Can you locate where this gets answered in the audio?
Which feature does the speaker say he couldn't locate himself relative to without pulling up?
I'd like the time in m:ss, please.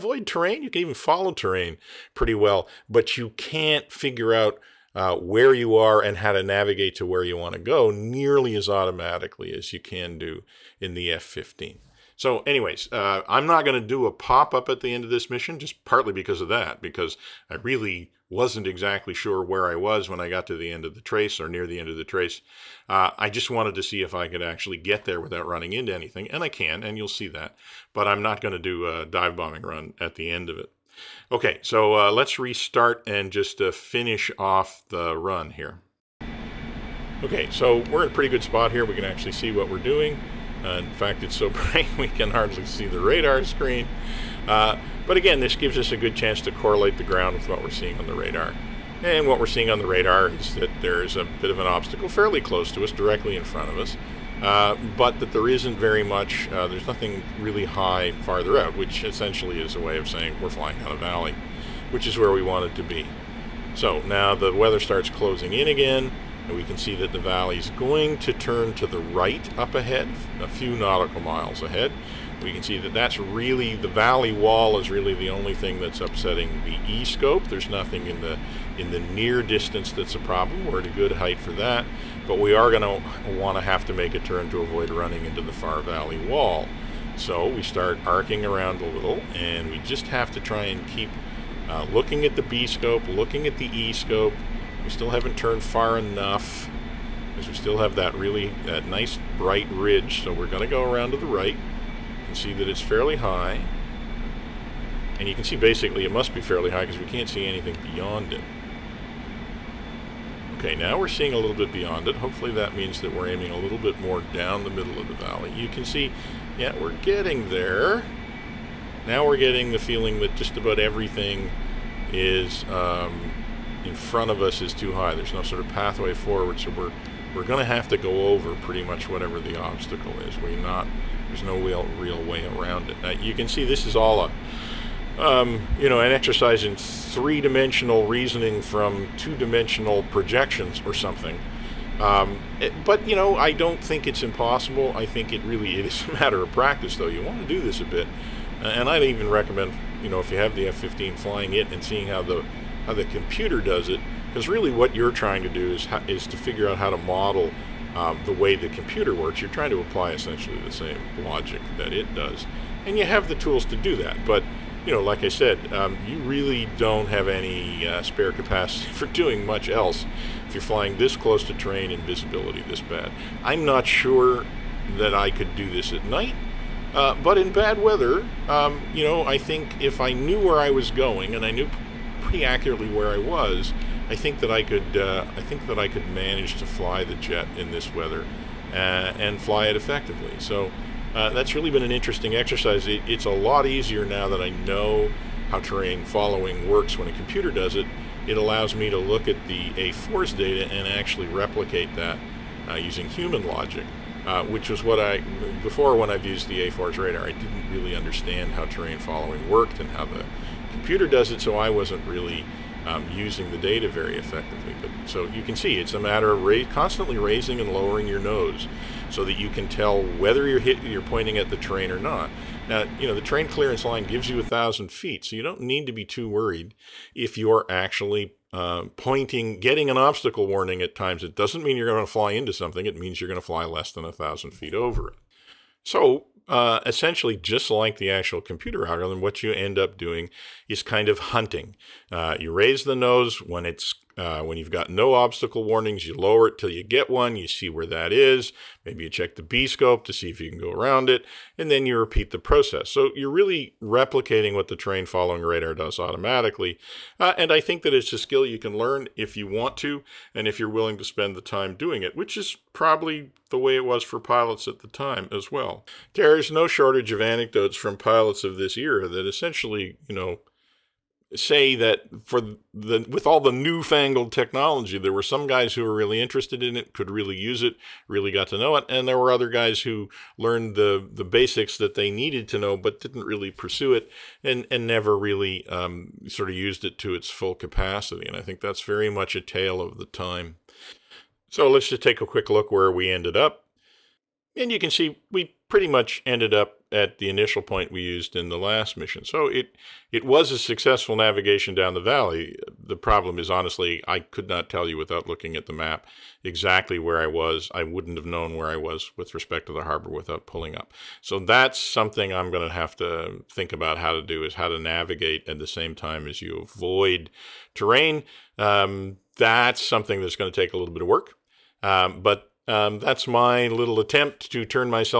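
5:09.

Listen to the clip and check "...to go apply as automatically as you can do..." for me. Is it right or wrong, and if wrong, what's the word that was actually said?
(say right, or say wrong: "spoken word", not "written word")
wrong: "nearly", not "apply".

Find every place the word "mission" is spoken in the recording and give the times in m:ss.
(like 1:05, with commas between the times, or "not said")
0:15, 4:58.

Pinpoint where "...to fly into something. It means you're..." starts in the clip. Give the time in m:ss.
3:52.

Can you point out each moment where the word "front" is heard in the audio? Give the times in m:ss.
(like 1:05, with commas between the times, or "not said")
0:53, 2:03.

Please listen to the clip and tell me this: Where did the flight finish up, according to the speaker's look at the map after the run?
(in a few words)
the initial point.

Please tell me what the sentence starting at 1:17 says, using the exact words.
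There's nothing in the, in the near distance that's a problem.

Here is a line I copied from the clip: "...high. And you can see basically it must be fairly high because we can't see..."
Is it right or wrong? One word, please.
right.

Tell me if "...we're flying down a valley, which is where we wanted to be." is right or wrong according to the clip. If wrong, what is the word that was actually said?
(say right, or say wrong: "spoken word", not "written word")
right.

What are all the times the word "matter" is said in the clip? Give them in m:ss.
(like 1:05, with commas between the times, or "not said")
2:26, 3:35.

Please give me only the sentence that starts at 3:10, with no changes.
So uh, that's really been an interesting exercise.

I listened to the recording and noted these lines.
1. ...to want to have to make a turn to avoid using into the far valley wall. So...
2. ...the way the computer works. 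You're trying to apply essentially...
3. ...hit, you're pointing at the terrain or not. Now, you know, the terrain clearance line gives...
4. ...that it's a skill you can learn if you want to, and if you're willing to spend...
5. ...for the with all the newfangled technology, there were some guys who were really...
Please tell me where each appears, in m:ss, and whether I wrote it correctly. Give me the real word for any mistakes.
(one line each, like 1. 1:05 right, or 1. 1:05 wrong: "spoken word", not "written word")
1. 1:23 wrong: "running", not "using"
2. 2:38 right
3. 3:40 right
4. 4:17 right
5. 4:32 right.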